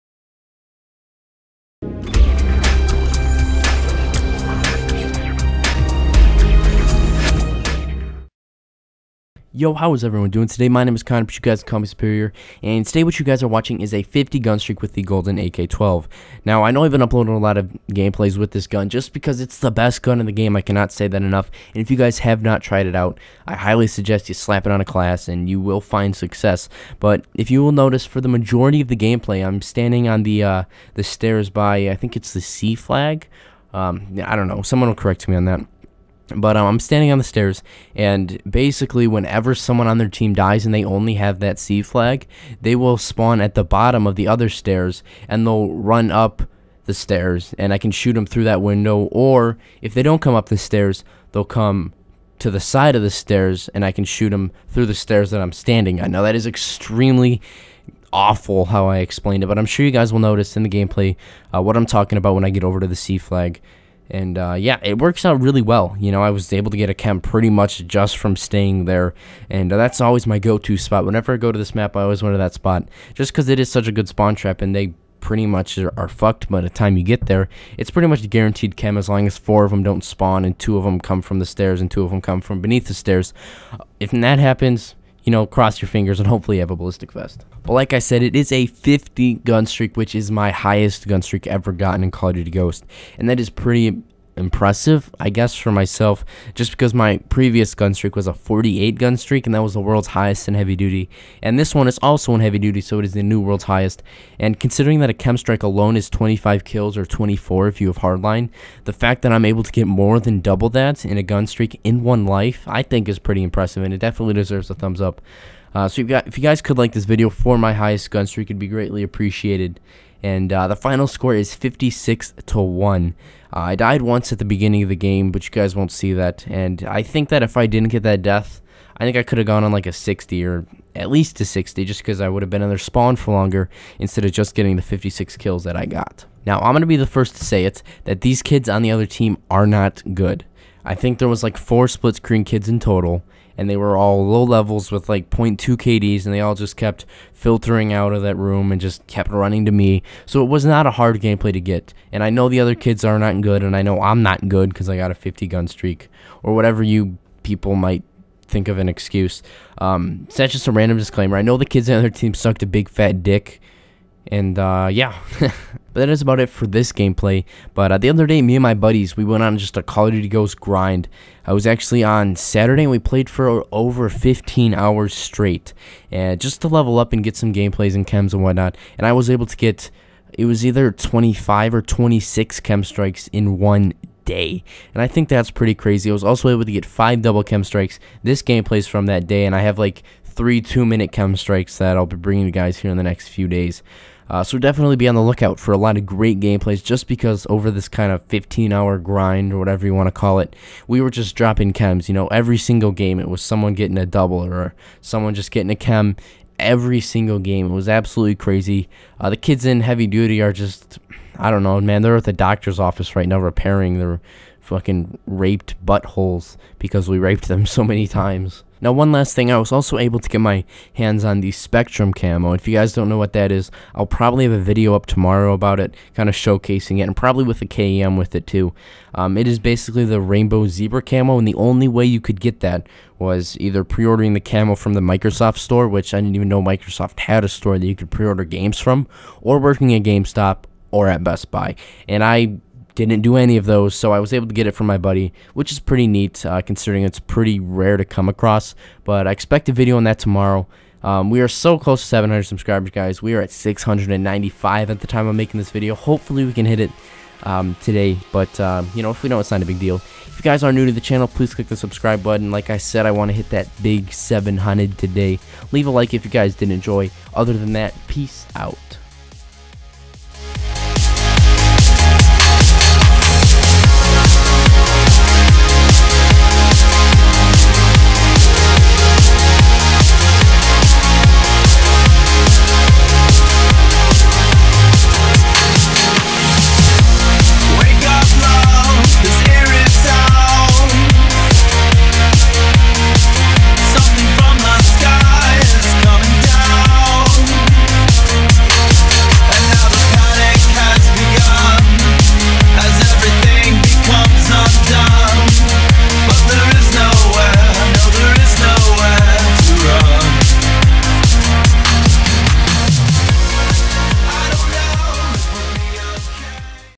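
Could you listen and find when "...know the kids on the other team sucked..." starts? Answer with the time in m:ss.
2:41.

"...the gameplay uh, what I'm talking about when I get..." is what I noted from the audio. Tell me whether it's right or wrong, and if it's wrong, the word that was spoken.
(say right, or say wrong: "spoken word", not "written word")
right.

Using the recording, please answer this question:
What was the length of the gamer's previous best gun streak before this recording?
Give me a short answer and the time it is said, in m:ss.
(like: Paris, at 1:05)
48, at 1:38.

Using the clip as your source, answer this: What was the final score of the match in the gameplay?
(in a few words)
56 to 1.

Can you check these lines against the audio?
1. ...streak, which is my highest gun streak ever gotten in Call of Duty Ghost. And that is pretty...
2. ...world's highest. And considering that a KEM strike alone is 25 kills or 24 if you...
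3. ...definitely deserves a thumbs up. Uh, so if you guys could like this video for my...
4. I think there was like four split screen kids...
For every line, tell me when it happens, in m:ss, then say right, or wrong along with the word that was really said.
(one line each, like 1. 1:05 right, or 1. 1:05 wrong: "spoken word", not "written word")
1. 1:29 right
2. 1:43 right
3. 1:53 right
4. 2:20 right.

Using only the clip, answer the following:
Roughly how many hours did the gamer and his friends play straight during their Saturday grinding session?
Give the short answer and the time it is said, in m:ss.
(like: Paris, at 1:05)
Over 15 hours, at 2:53.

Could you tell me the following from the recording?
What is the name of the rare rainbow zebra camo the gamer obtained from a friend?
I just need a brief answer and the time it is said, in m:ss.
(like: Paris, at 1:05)
Spectrum, at 3:41.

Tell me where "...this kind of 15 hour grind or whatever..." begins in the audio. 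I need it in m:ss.
3:17.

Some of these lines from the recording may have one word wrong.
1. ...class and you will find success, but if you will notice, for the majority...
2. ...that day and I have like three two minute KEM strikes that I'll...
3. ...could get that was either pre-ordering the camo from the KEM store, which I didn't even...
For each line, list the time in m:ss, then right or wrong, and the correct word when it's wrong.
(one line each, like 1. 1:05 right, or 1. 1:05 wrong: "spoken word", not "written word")
1. 0:24 right
2. 3:09 right
3. 3:52 wrong: "Microsoft", not "KEM".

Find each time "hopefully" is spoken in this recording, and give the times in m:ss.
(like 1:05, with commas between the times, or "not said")
1:26, 4:15.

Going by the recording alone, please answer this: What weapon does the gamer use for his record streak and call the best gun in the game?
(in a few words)
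Golden AK-12.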